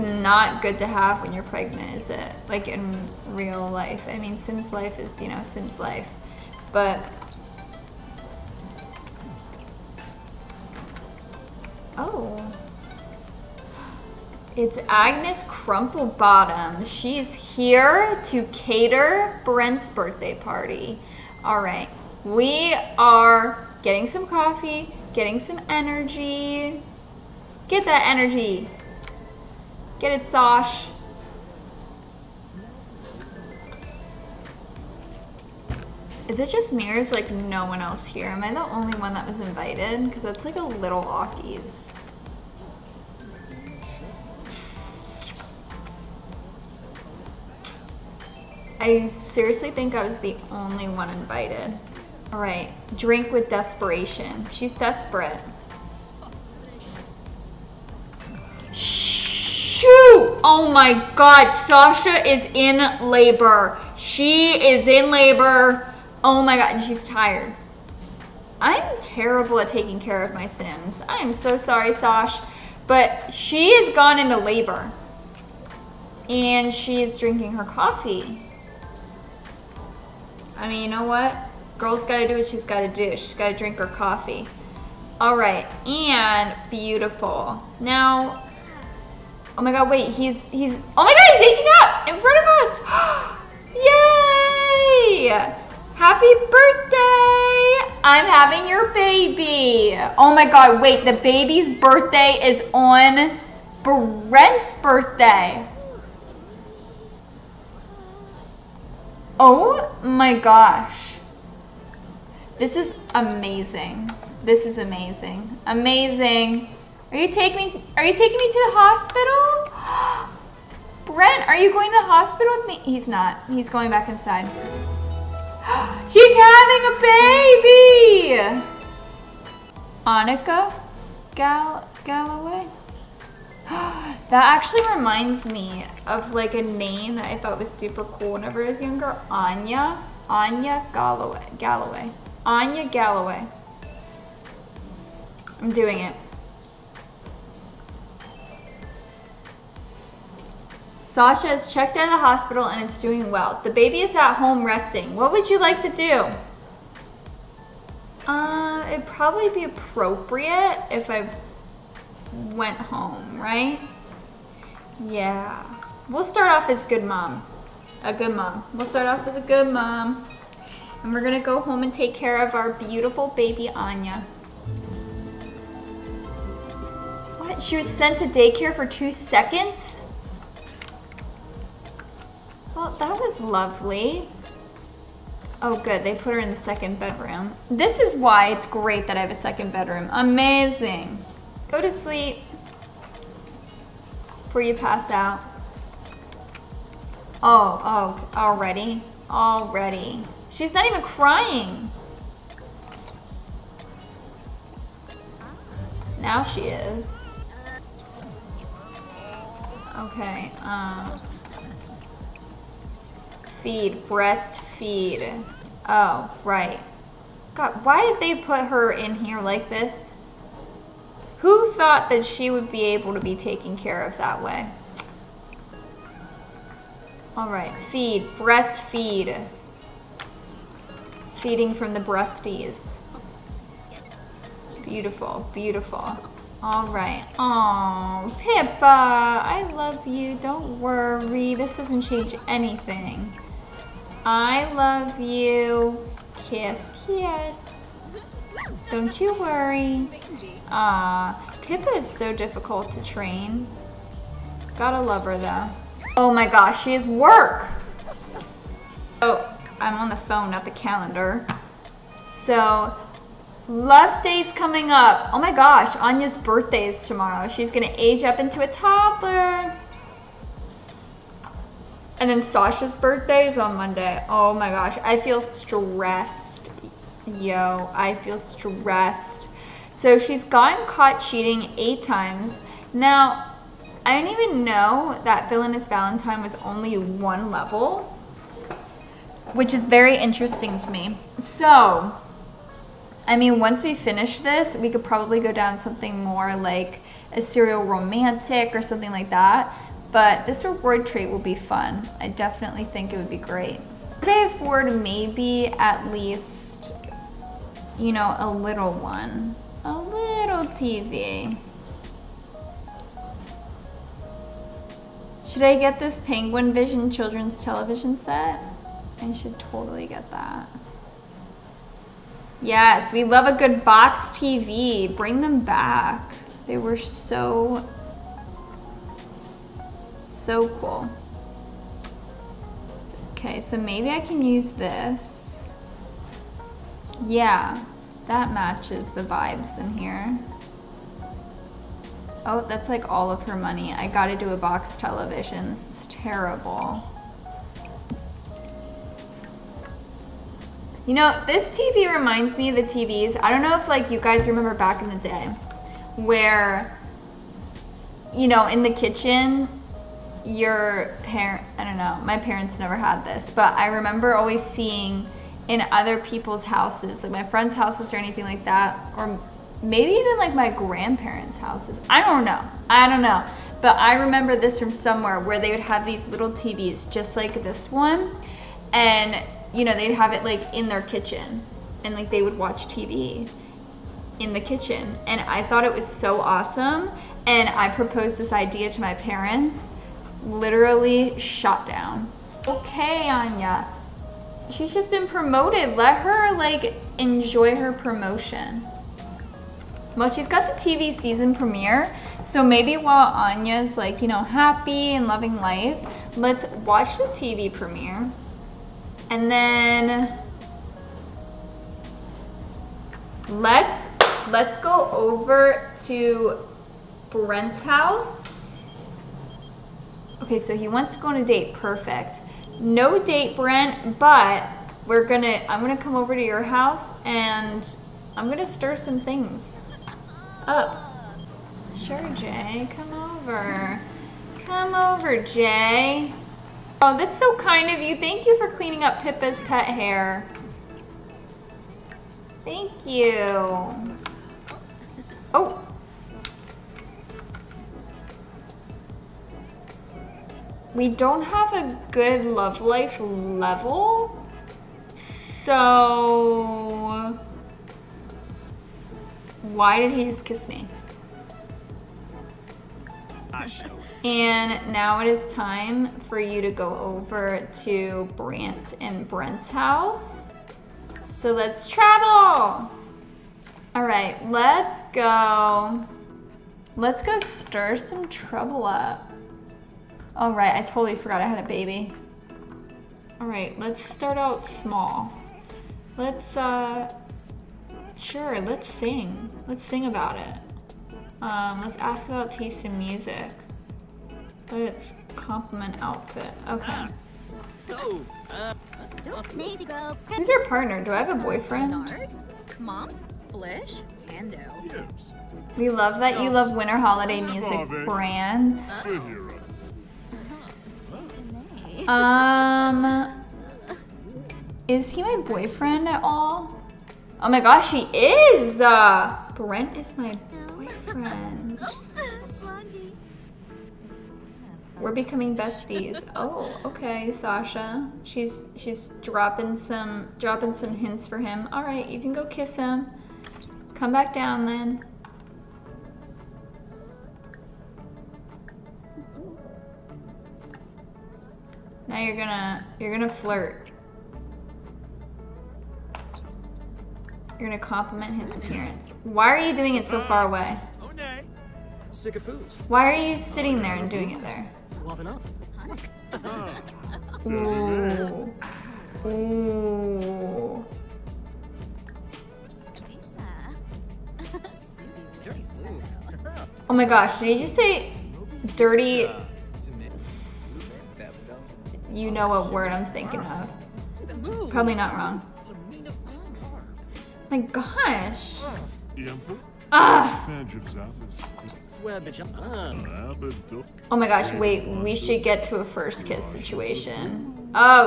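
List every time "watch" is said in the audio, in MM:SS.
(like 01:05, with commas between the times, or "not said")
06:22, 06:46.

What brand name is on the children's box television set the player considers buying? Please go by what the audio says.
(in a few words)
Penguin Vision.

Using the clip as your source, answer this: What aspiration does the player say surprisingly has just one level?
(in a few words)
Villainous Valentine.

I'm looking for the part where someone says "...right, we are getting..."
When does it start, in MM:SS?
00:21.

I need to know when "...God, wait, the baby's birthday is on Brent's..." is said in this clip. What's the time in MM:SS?
01:40.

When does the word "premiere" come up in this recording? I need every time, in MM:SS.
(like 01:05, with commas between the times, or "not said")
06:41, 06:47.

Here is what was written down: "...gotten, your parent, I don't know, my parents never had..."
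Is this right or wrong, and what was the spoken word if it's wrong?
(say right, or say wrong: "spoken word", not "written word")
wrong: "kitchen", not "gotten".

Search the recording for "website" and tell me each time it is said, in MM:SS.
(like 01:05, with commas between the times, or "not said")
not said.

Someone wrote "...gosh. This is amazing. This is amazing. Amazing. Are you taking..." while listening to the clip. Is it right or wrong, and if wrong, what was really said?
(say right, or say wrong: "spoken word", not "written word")
right.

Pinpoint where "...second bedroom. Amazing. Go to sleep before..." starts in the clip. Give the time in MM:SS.
03:09.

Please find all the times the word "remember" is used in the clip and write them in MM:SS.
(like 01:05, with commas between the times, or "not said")
05:54, 06:03, 06:14.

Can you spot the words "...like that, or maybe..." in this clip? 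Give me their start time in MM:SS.
06:08.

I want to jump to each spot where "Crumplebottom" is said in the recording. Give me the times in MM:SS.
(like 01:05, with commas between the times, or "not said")
00:15.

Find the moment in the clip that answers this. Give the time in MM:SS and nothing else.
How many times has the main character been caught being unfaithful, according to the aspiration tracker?
04:41.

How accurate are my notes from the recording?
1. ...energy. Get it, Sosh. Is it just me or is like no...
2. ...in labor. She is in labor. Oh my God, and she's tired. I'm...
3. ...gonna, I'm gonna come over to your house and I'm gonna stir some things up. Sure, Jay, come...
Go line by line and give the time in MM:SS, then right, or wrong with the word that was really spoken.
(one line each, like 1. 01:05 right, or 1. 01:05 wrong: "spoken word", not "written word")
1. 00:28 right
2. 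01:02 right
3. 07:05 right.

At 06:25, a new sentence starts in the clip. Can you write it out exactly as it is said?
And I thought it was so awesome.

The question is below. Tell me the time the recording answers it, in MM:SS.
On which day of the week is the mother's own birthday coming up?
04:33.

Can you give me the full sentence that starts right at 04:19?
Oh, I'm on the phone, not the calendar.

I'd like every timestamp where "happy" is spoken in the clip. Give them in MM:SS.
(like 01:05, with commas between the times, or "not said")
01:35, 06:44.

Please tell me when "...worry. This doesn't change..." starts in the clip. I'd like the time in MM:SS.
04:00.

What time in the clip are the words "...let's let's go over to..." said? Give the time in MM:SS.
06:53.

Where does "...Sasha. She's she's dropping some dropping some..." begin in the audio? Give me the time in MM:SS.
08:47.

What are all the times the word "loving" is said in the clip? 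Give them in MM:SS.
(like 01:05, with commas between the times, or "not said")
06:45.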